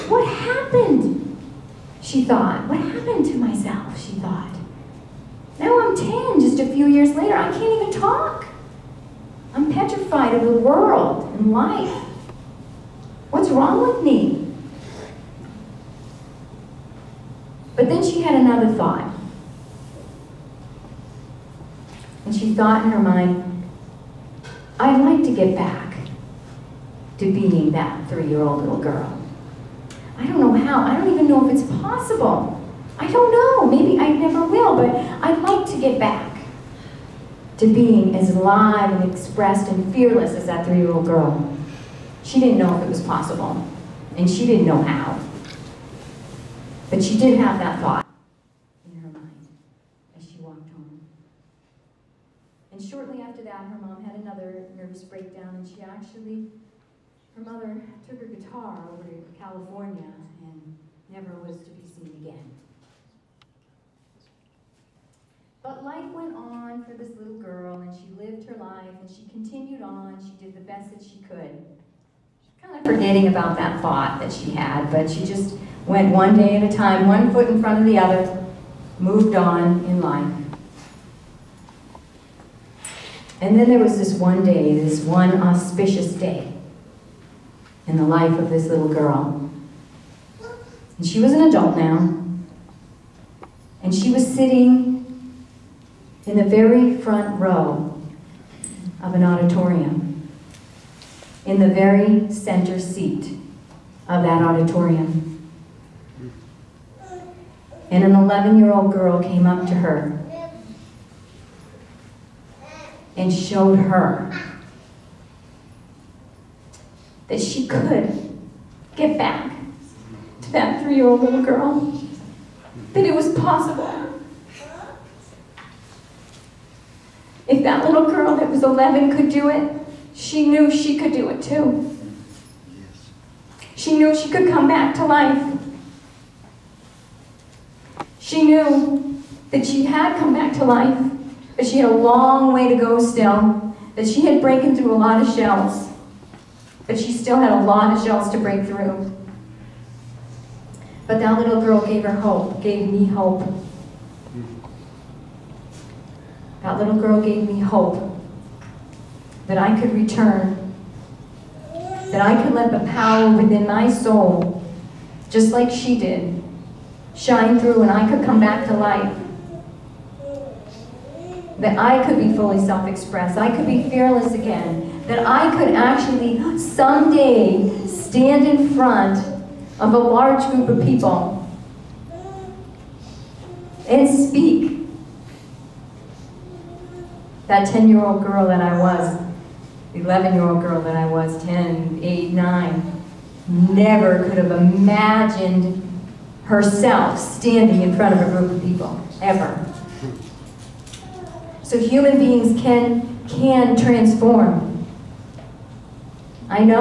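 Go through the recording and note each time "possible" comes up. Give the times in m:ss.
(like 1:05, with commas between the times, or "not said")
0:31, 0:43, 2:03.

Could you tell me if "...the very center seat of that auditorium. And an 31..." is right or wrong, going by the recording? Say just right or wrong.
wrong.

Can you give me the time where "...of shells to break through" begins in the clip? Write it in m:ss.
2:27.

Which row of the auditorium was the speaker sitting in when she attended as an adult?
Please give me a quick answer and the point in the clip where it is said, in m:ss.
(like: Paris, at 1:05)
front row, at 1:36.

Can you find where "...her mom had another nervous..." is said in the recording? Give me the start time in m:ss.
0:53.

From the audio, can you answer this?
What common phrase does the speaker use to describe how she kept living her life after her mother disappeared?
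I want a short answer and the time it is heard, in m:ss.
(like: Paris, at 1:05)
one day at a time, at 1:16.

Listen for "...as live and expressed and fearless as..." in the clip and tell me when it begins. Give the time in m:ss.
0:38.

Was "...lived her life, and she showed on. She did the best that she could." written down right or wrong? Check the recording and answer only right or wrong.
wrong.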